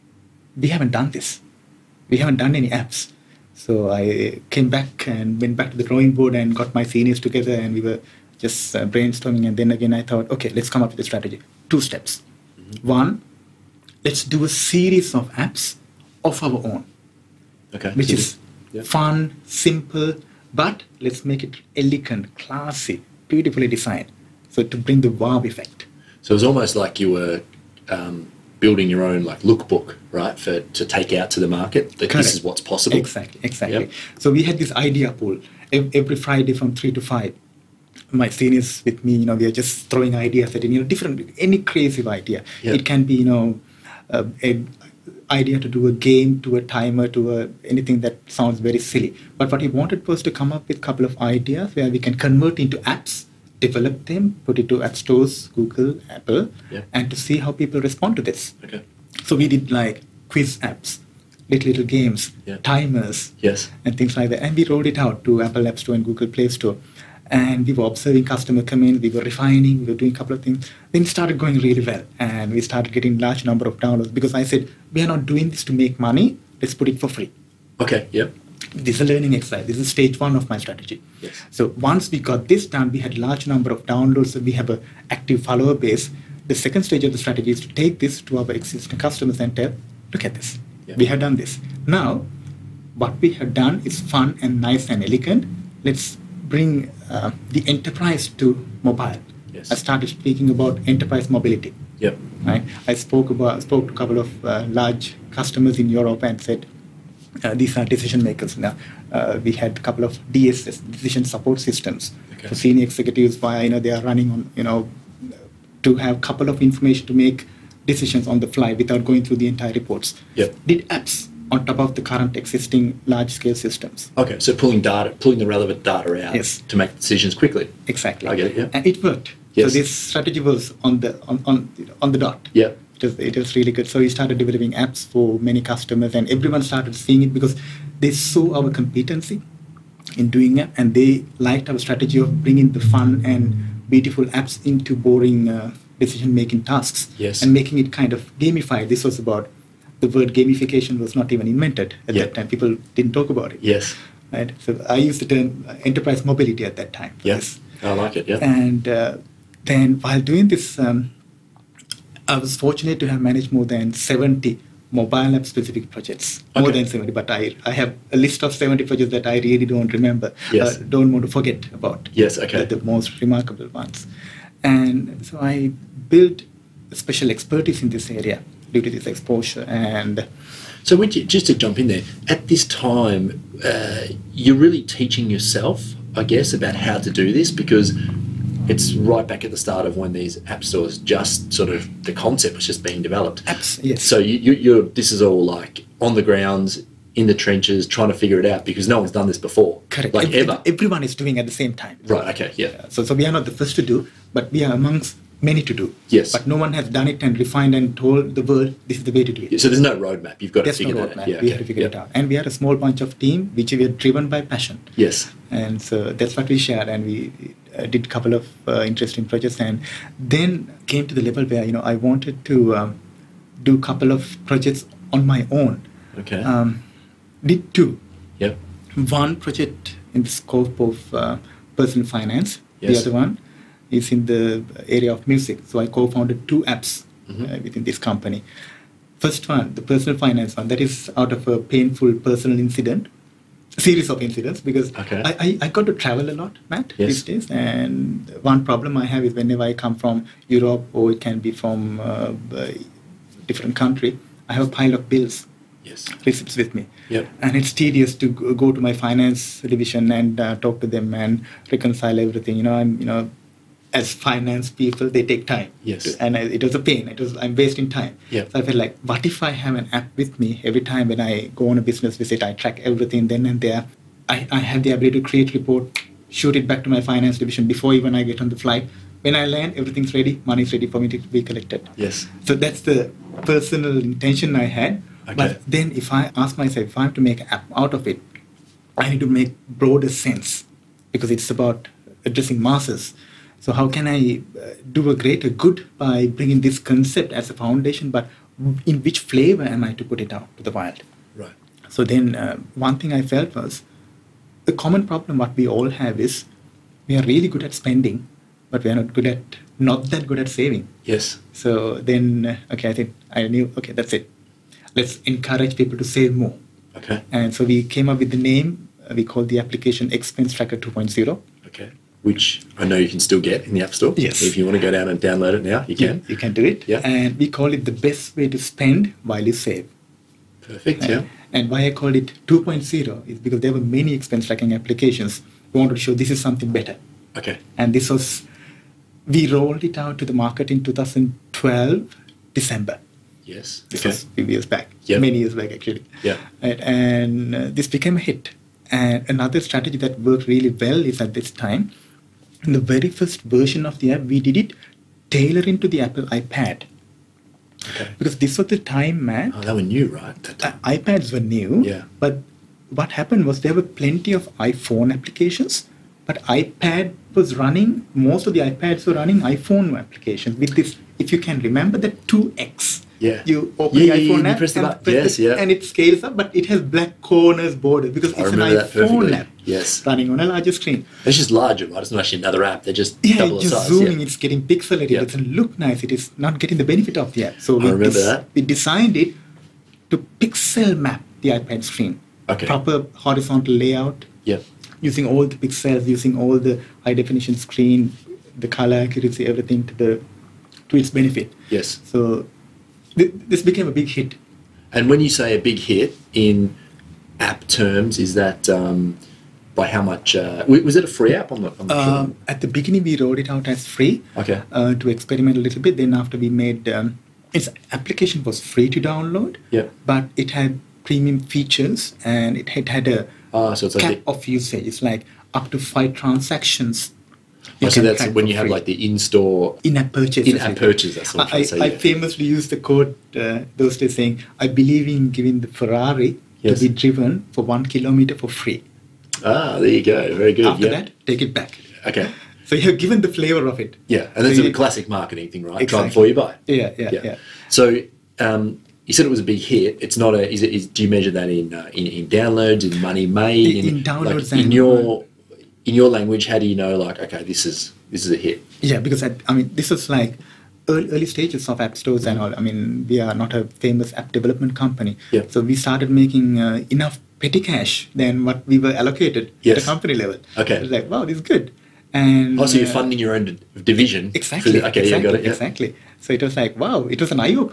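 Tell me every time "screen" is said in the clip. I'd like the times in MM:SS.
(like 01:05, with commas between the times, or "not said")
06:20, 06:31, 06:37.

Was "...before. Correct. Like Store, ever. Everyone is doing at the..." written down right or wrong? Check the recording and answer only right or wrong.
wrong.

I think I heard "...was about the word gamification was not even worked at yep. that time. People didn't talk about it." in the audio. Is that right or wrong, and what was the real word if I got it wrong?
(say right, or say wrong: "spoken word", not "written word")
wrong: "invented", not "worked".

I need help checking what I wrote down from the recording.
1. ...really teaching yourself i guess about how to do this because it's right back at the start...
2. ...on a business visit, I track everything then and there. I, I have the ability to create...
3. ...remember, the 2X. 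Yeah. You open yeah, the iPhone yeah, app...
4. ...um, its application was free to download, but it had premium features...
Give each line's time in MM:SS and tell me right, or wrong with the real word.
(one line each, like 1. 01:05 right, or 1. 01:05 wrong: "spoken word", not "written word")
1. 03:04 right
2. 04:31 right
3. 06:11 right
4. 06:56 right.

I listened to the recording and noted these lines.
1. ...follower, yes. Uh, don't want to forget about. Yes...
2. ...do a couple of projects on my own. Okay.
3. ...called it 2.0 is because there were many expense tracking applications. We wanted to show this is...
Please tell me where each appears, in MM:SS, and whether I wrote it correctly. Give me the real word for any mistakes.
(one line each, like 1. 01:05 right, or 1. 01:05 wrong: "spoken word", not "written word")
1. 02:49 wrong: "remember", not "follower"
2. 03:43 right
3. 05:31 right.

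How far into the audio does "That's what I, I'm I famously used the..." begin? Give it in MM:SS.
07:11.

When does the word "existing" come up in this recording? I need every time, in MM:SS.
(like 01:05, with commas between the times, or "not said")
01:28, 02:02.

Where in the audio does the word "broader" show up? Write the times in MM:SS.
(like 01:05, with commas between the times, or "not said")
04:49.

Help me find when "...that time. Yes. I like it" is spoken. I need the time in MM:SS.
02:36.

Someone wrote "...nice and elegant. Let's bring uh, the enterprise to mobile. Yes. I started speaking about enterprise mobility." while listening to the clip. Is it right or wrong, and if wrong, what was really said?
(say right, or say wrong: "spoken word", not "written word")
right.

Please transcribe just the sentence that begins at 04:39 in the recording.
When I land, everything's ready, money's ready for me to be collected.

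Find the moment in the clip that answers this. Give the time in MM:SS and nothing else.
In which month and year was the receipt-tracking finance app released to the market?
05:40.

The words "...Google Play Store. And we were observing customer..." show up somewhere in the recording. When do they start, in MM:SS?
01:06.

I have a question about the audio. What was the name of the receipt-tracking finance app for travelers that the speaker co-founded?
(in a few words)
Expense Tracker 2.0.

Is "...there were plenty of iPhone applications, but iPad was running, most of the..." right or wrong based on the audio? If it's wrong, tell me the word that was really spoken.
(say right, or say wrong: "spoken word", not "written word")
right.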